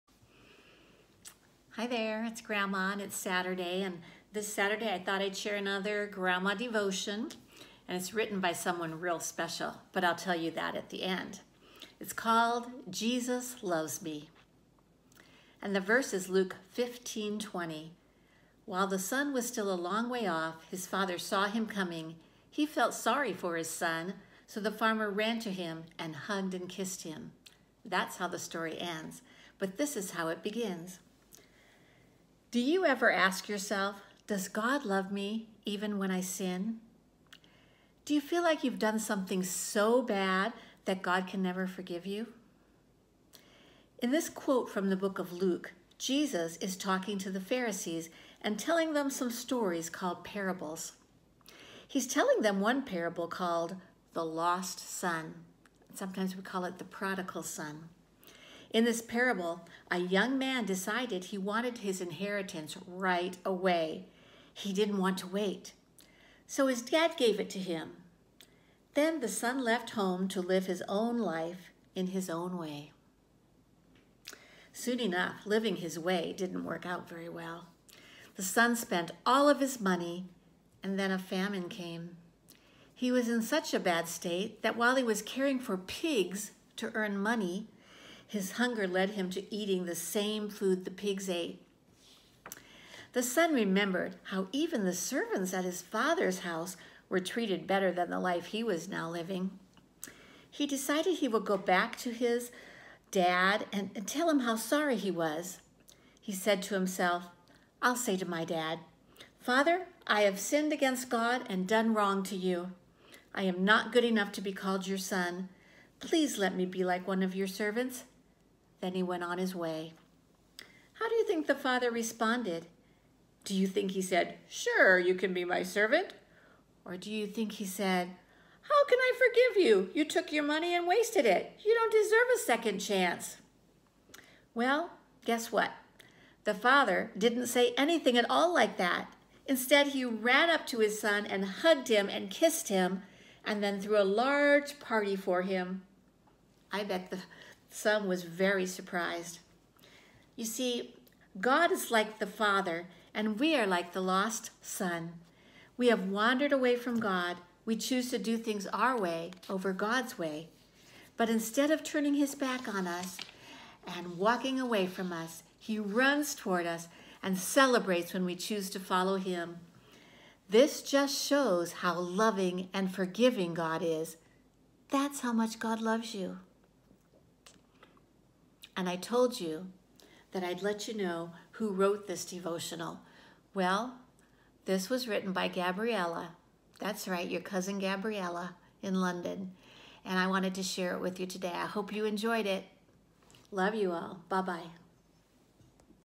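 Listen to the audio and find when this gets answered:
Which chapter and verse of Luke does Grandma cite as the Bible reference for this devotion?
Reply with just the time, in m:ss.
0:16.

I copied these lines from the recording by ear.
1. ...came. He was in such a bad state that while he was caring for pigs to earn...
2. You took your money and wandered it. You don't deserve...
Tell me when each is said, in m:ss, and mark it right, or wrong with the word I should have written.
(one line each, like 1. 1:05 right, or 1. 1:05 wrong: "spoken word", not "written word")
1. 1:21 right
2. 2:09 wrong: "wasted", not "wandered".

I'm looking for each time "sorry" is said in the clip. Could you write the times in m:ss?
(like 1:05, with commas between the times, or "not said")
0:22, 1:44.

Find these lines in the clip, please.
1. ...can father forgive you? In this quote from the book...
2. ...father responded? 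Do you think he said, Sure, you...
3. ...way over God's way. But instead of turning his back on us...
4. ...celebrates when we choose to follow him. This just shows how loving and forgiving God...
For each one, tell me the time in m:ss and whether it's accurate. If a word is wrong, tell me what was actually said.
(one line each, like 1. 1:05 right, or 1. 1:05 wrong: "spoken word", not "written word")
1. 0:41 wrong: "never", not "father"
2. 2:01 right
3. 2:38 right
4. 2:47 right.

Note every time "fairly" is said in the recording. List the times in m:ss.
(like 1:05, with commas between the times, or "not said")
not said.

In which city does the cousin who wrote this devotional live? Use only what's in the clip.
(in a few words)
London.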